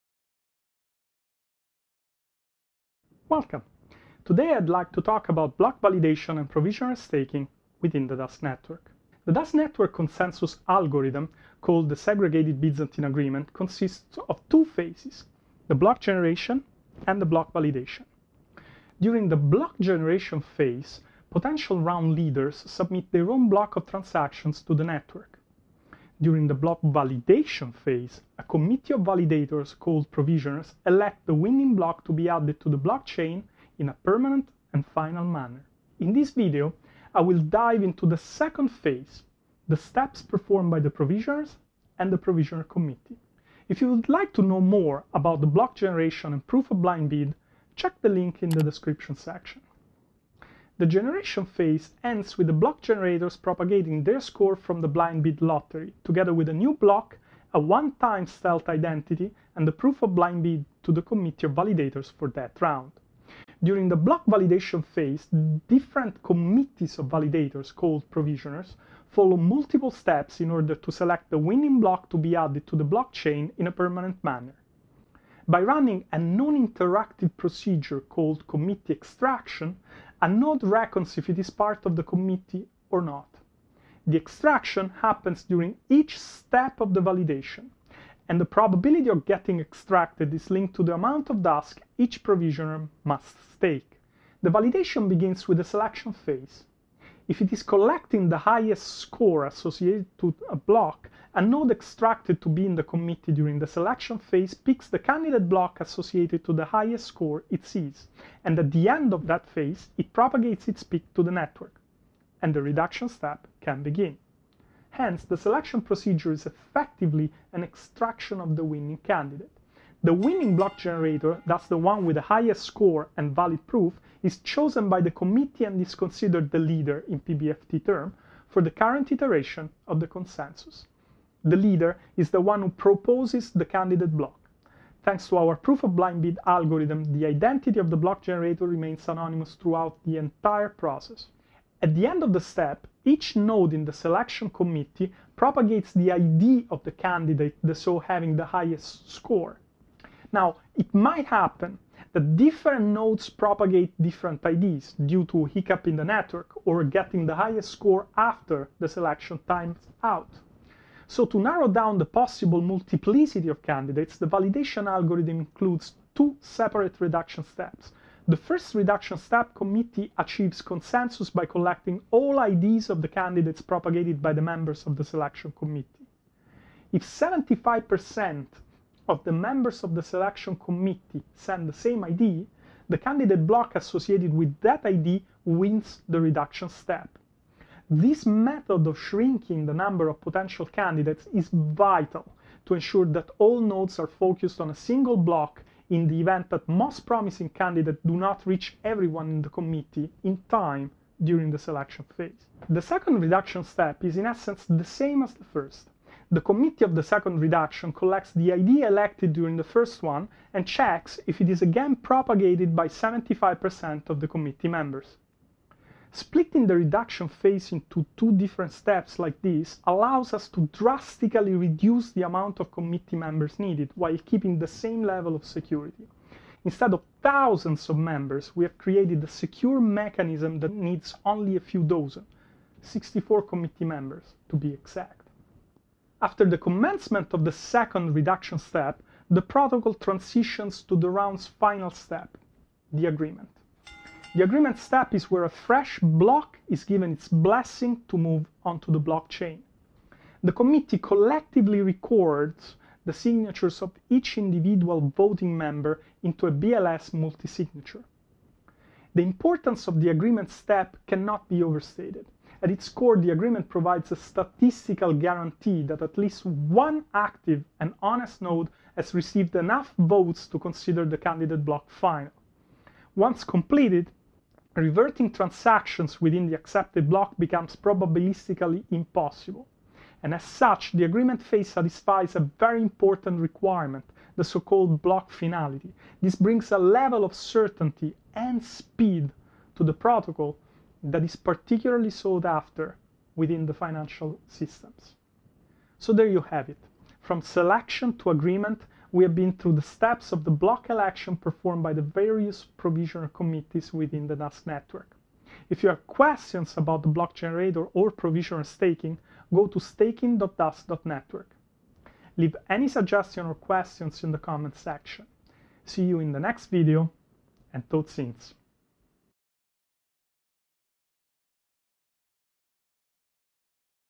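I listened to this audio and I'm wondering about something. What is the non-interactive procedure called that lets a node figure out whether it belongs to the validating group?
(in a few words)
committee extraction.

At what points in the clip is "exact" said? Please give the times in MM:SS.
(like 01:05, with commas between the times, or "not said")
03:54.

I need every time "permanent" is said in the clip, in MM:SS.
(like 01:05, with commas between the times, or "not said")
00:34, 01:13.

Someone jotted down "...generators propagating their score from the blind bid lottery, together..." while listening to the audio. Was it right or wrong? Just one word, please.
right.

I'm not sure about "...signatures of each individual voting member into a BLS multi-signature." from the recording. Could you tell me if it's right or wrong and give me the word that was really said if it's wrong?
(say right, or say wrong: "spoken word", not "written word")
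right.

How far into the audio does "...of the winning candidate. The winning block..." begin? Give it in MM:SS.
01:58.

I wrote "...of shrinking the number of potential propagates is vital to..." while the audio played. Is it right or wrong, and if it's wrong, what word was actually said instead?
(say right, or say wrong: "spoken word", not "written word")
wrong: "candidates", not "propagates".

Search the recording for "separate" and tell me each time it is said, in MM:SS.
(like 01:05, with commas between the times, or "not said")
02:46.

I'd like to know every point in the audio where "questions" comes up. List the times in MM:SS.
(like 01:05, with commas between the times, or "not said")
05:06, 05:13.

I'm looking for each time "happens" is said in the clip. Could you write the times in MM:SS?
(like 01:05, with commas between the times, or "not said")
01:25, 02:31.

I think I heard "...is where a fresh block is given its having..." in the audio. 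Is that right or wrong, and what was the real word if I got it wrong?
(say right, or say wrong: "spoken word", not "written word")
wrong: "blessing", not "having".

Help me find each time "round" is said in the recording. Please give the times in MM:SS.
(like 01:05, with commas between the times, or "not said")
00:21, 01:02, 04:01.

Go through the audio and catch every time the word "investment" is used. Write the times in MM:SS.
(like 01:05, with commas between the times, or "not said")
not said.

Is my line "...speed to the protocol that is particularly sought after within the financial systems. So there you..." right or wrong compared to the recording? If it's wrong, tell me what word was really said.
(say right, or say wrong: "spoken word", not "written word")
right.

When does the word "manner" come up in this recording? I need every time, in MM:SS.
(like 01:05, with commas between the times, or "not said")
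00:35, 01:14.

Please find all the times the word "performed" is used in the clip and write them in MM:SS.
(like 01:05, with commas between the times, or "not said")
00:40, 05:01.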